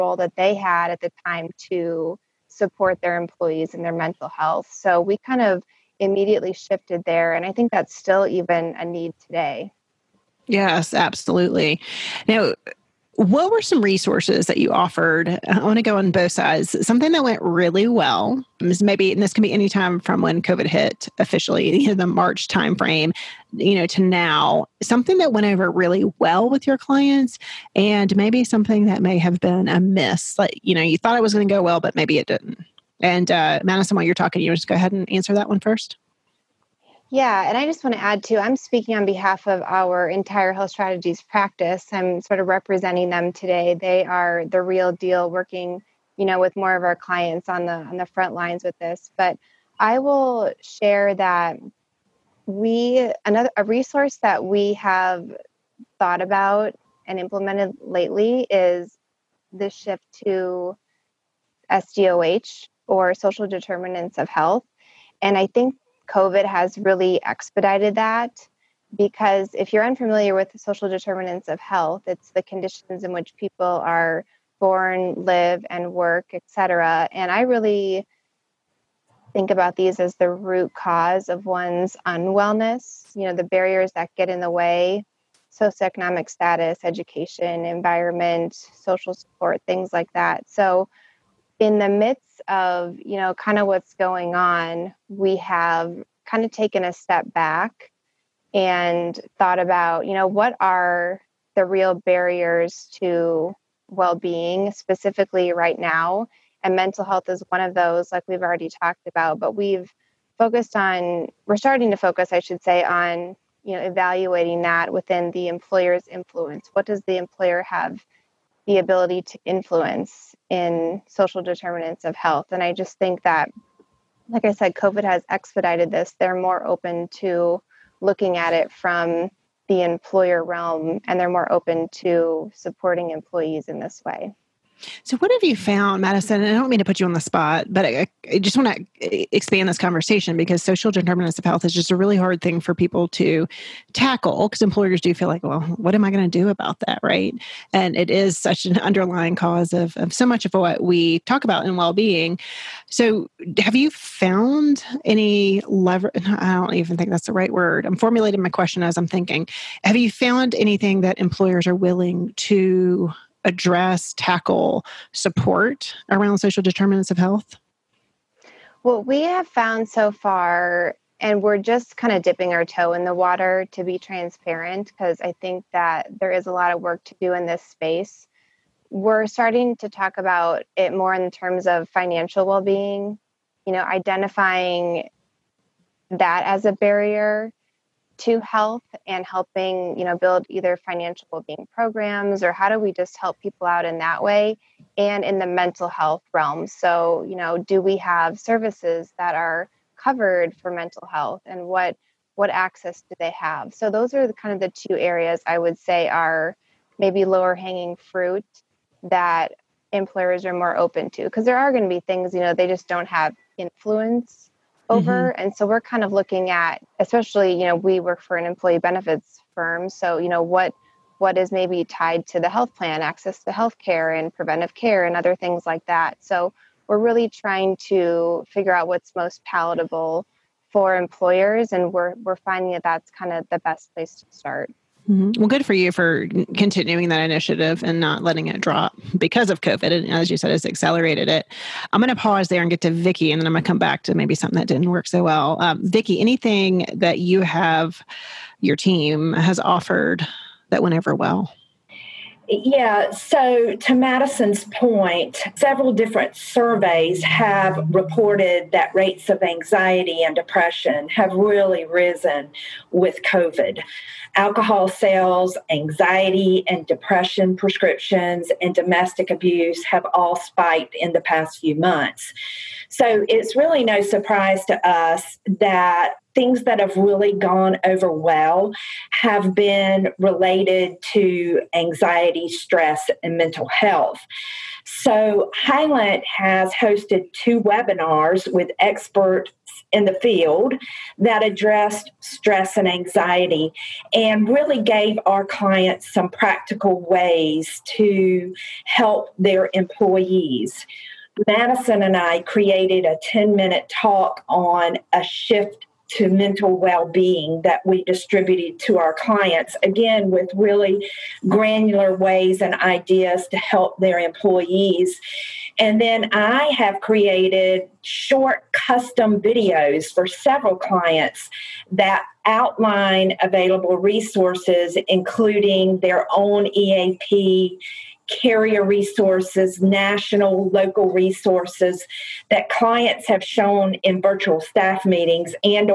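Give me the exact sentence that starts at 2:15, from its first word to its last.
So, what have you found, Maddison?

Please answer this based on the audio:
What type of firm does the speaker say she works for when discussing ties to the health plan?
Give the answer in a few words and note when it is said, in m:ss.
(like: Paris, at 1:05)
Employee benefits firm, at 3:38.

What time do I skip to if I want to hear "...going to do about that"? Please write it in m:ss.
2:26.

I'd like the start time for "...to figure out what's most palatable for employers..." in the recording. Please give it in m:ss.
3:47.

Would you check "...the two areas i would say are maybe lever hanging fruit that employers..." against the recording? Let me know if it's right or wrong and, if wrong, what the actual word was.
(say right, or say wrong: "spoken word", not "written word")
wrong: "lower", not "lever".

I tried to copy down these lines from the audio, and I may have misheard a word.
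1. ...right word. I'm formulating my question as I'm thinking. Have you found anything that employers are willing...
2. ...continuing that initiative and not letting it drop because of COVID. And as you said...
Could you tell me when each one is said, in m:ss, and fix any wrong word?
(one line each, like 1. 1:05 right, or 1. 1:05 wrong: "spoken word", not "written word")
1. 2:37 right
2. 3:56 right.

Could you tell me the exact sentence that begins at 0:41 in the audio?
I'm sort of representing them today.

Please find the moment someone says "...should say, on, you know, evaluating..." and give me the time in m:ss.
1:52.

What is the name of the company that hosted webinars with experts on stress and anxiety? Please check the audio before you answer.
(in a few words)
Hylant.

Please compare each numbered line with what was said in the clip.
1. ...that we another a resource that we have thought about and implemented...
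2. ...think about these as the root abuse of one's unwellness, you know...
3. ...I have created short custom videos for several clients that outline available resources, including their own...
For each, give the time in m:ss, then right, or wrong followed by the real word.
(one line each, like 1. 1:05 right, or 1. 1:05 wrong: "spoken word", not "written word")
1. 0:51 right
2. 1:19 wrong: "cause", not "abuse"
3. 5:16 right.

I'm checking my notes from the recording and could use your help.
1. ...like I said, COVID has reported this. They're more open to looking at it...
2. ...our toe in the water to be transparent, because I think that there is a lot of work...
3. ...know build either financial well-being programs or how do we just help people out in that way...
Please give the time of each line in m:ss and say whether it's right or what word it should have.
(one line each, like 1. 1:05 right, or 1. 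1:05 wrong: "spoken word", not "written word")
1. 2:04 wrong: "expedited", not "reported"
2. 2:52 right
3. 3:10 right.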